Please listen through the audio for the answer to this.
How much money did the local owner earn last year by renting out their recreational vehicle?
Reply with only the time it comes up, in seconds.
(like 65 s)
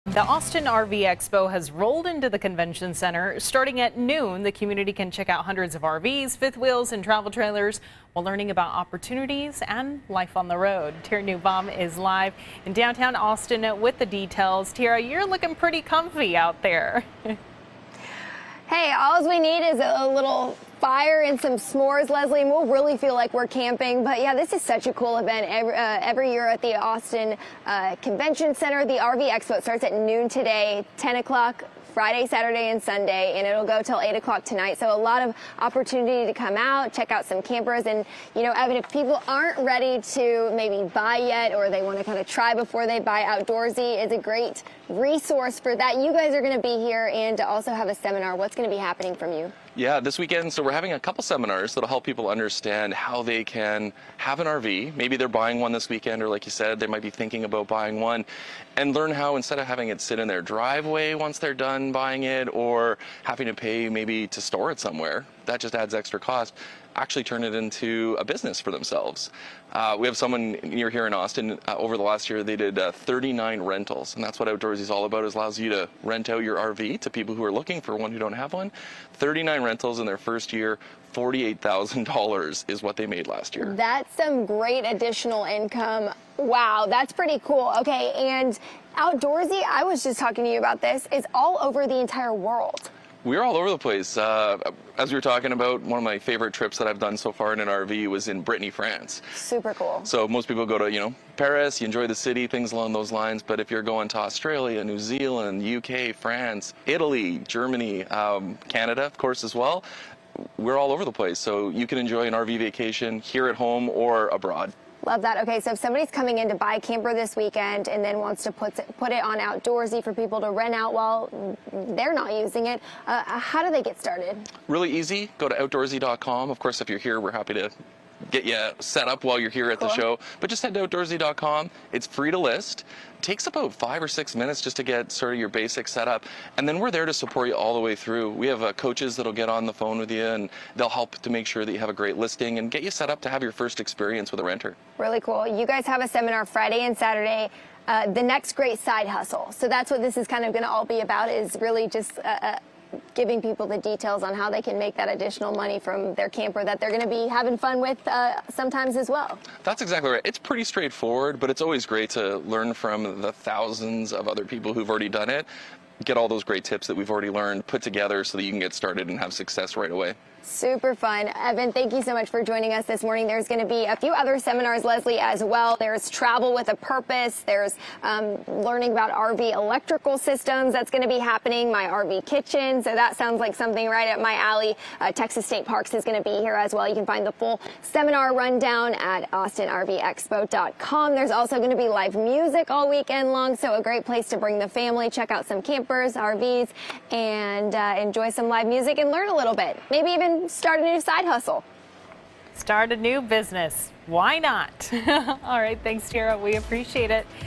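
81 s.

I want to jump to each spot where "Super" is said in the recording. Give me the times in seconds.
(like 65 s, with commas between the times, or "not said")
99 s, 170 s.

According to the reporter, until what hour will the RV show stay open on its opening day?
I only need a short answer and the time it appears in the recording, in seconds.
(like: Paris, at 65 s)
8 o'clock, at 33 s.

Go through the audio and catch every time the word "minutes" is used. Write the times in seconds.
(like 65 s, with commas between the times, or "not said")
134 s.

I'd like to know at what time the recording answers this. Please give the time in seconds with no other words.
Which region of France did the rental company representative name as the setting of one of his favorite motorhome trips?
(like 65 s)
98 s.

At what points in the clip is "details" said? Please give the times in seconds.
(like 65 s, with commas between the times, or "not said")
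14 s, 153 s.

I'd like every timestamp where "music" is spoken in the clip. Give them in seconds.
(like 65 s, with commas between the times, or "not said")
192 s, 198 s.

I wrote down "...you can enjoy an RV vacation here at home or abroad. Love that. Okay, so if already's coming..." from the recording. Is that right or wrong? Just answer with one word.
wrong.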